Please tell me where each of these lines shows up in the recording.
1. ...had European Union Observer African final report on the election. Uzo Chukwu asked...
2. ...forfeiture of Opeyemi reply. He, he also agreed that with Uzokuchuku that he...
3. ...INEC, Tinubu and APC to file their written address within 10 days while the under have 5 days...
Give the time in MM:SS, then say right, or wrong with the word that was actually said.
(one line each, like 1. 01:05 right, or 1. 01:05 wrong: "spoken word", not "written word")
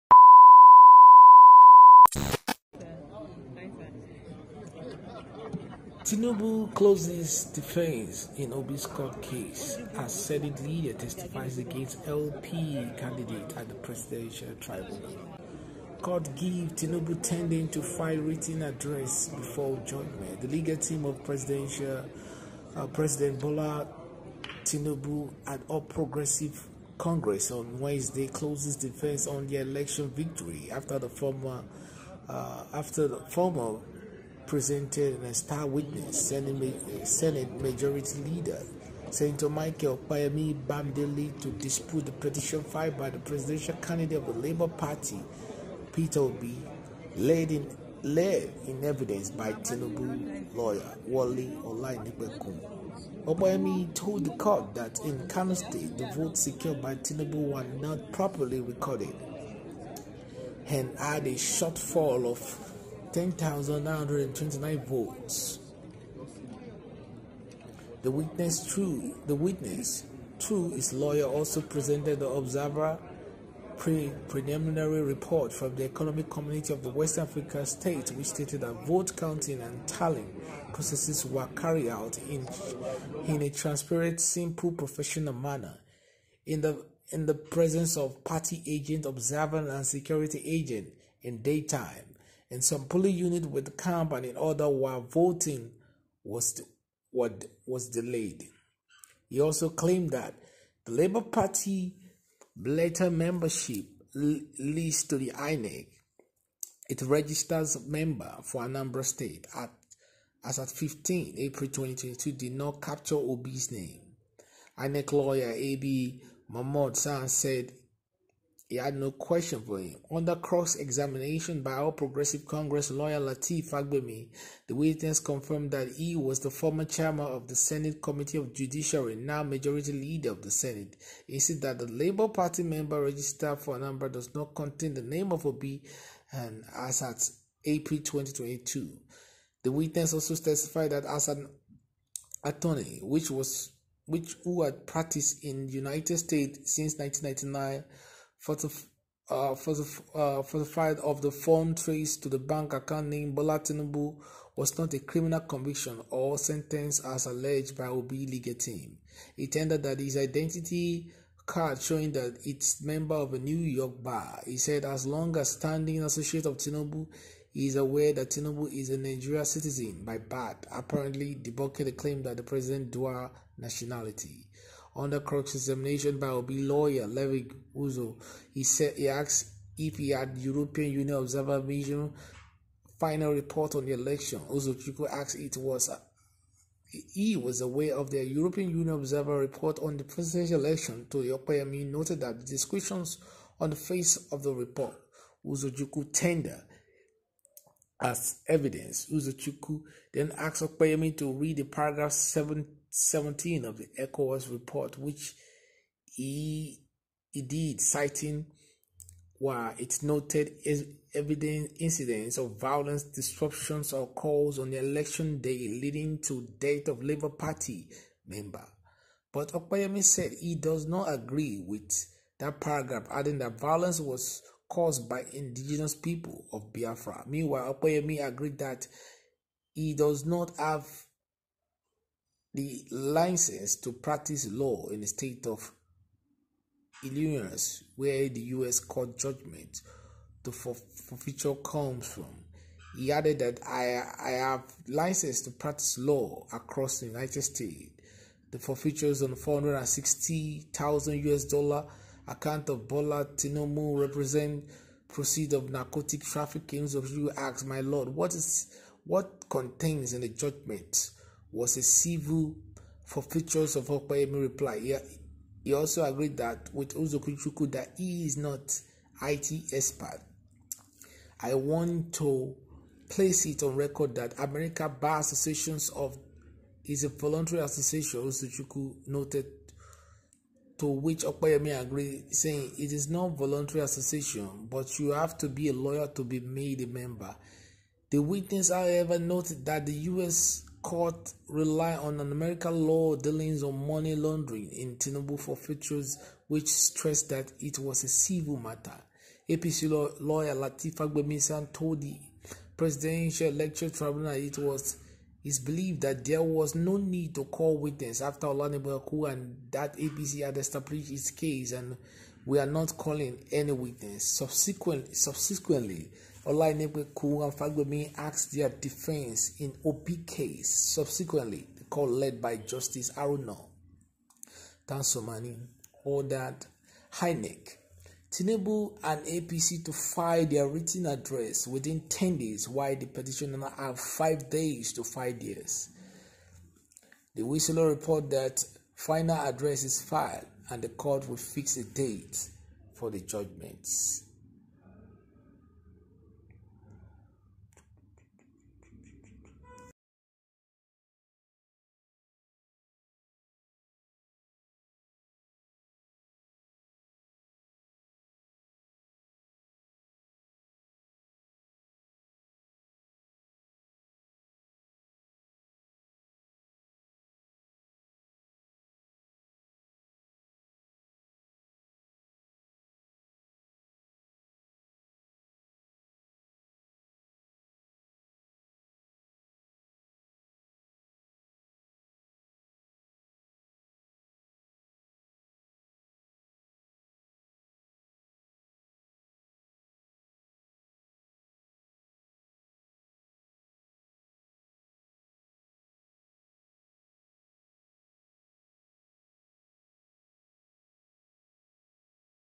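1. 03:00 wrong: "Mission", not "African"
2. 04:23 right
3. 05:27 wrong: "petitioner", not "under".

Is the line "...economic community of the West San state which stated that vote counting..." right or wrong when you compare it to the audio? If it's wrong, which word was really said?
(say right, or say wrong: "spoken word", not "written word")
wrong: "African", not "San".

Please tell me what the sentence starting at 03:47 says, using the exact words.
Meanwhile, Opeyemi agreed that he does not have the license to practice law in the state of Illinois, where the U.S.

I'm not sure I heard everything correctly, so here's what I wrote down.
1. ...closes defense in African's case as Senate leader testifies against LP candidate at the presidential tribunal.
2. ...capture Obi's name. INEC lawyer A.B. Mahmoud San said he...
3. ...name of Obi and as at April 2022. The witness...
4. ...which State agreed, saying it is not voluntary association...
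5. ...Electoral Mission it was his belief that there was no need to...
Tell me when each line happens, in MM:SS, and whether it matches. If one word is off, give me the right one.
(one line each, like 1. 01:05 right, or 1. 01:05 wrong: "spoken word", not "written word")
1. 00:06 wrong: "Obi", not "African"
2. 01:52 right
3. 02:15 right
4. 04:40 wrong: "Opeyemi", not "State"
5. 05:03 wrong: "Tribunal", not "Mission".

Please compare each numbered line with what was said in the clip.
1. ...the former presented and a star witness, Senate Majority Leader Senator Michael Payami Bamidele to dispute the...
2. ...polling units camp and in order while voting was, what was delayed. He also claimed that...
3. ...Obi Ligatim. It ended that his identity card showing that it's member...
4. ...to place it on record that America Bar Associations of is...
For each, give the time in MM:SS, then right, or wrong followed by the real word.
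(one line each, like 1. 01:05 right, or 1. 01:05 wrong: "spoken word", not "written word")
1. 00:33 right
2. 01:32 right
3. 02:37 right
4. 04:32 right.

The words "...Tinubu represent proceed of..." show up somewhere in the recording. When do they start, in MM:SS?
04:13.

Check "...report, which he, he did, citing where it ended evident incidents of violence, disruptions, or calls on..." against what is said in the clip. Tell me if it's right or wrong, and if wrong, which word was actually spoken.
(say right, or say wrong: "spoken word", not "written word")
wrong: "noted", not "ended".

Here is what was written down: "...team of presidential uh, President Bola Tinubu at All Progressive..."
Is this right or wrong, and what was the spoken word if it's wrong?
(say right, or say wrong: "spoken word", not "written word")
right.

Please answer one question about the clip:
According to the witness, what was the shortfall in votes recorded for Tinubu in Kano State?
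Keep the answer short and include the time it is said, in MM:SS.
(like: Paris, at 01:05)
10,929, at 01:03.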